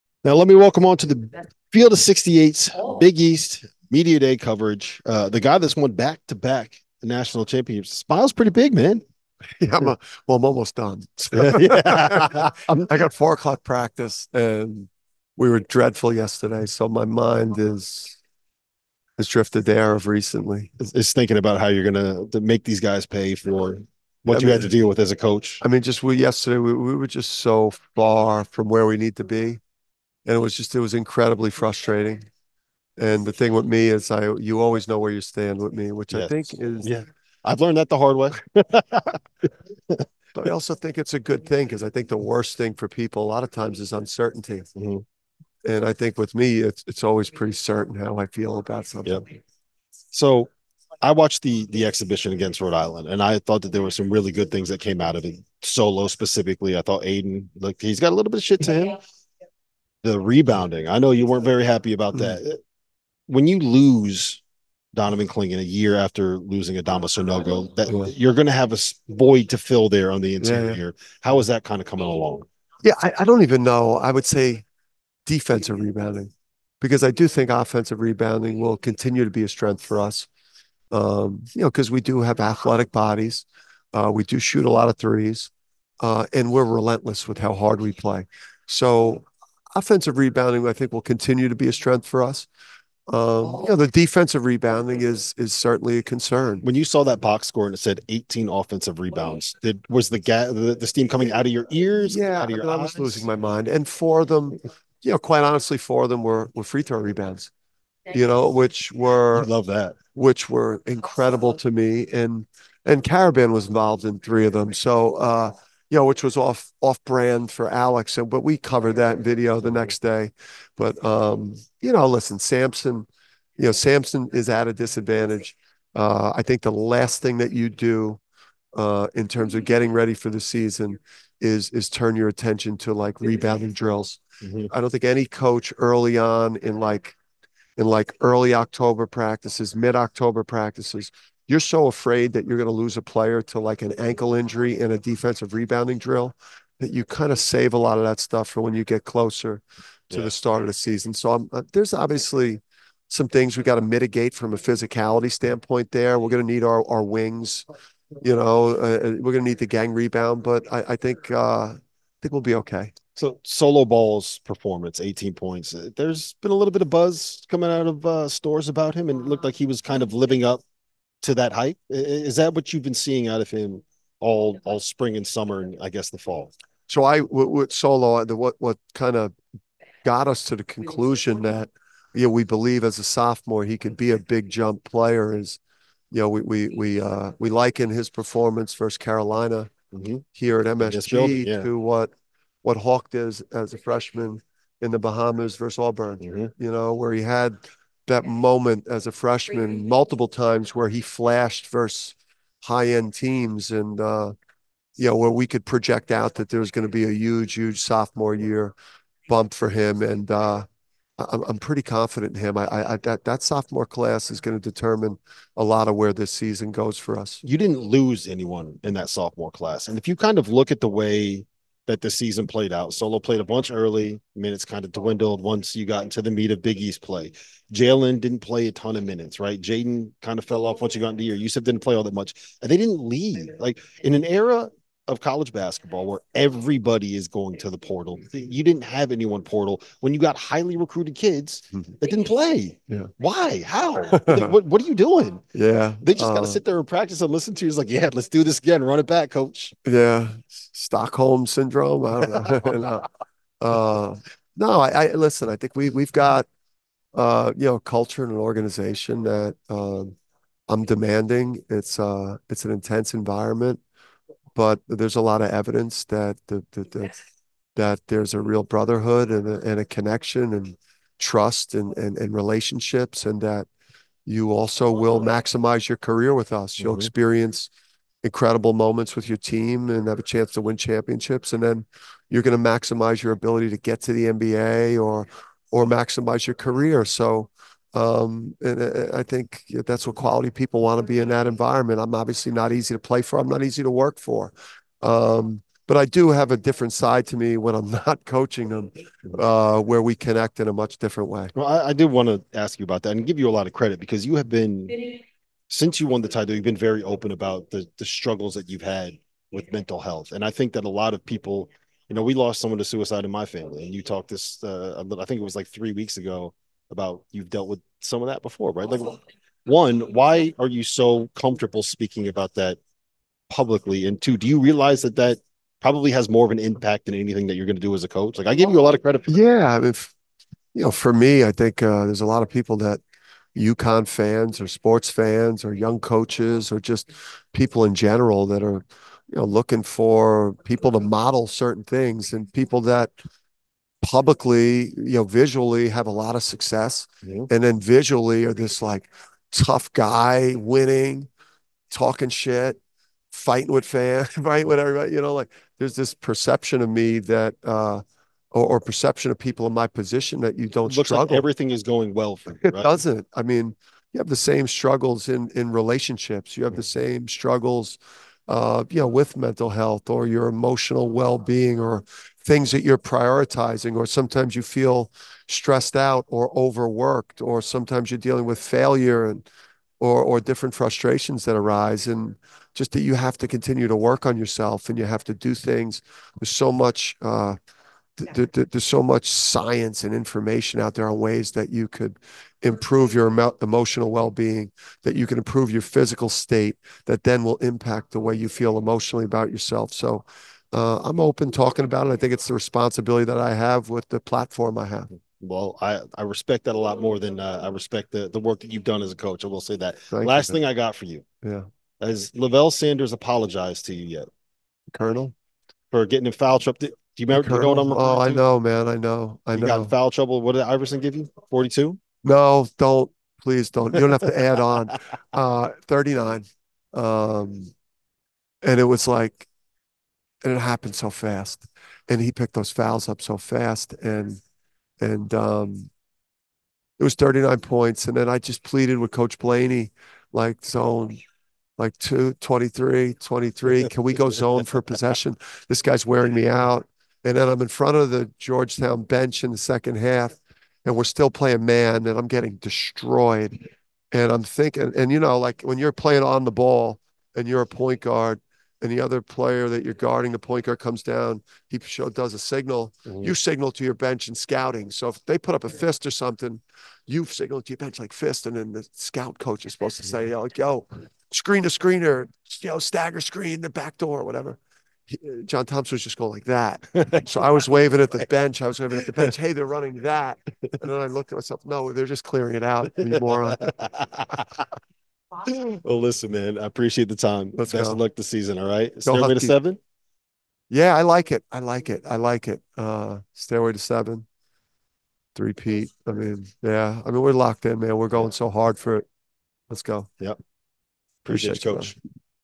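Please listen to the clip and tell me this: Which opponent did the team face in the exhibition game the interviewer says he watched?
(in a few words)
Rhode Island.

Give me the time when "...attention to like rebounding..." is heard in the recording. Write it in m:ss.
2:12.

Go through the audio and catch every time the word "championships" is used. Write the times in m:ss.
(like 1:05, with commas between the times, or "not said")
0:07, 4:40.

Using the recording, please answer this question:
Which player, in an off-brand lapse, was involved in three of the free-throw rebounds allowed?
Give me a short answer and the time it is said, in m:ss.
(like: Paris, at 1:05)
Karaban, at 1:53.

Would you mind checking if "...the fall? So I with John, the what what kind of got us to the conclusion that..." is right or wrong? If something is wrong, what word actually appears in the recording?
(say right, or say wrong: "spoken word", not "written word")
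wrong: "Solo", not "John".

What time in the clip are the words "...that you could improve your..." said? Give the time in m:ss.
6:31.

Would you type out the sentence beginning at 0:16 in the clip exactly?
So my mind is has drifted there of recently.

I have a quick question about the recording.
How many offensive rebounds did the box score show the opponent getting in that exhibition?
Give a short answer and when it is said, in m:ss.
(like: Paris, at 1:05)
18, at 1:38.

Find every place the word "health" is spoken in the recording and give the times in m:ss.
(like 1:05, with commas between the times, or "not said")
5:09, 6:09.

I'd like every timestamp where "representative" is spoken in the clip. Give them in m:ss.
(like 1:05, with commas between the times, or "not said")
not said.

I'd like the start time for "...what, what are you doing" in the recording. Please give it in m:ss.
4:04.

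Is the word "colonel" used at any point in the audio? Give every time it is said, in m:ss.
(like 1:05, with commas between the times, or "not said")
6:54.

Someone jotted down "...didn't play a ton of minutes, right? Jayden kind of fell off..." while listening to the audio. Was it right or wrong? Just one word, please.
right.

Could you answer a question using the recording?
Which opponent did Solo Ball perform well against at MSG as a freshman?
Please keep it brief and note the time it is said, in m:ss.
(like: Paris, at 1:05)
Carolina, at 3:08.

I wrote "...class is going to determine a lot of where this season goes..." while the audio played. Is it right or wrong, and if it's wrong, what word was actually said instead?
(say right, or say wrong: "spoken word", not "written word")
right.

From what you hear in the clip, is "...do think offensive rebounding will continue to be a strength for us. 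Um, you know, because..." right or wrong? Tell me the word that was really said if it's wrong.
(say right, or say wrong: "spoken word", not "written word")
right.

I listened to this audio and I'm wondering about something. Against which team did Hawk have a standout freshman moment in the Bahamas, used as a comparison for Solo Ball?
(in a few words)
Auburn.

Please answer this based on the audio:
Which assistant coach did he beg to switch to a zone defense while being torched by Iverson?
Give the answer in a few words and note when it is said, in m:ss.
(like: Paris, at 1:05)
Coach Blaney, at 7:19.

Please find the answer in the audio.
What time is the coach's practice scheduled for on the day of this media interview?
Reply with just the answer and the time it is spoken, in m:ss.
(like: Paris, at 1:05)
4 o'clock, at 0:13.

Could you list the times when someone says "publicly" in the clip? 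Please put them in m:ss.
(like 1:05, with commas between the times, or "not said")
5:23, 5:44.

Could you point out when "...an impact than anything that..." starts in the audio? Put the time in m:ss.
5:26.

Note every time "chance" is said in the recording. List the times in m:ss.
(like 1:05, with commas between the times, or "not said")
4:40.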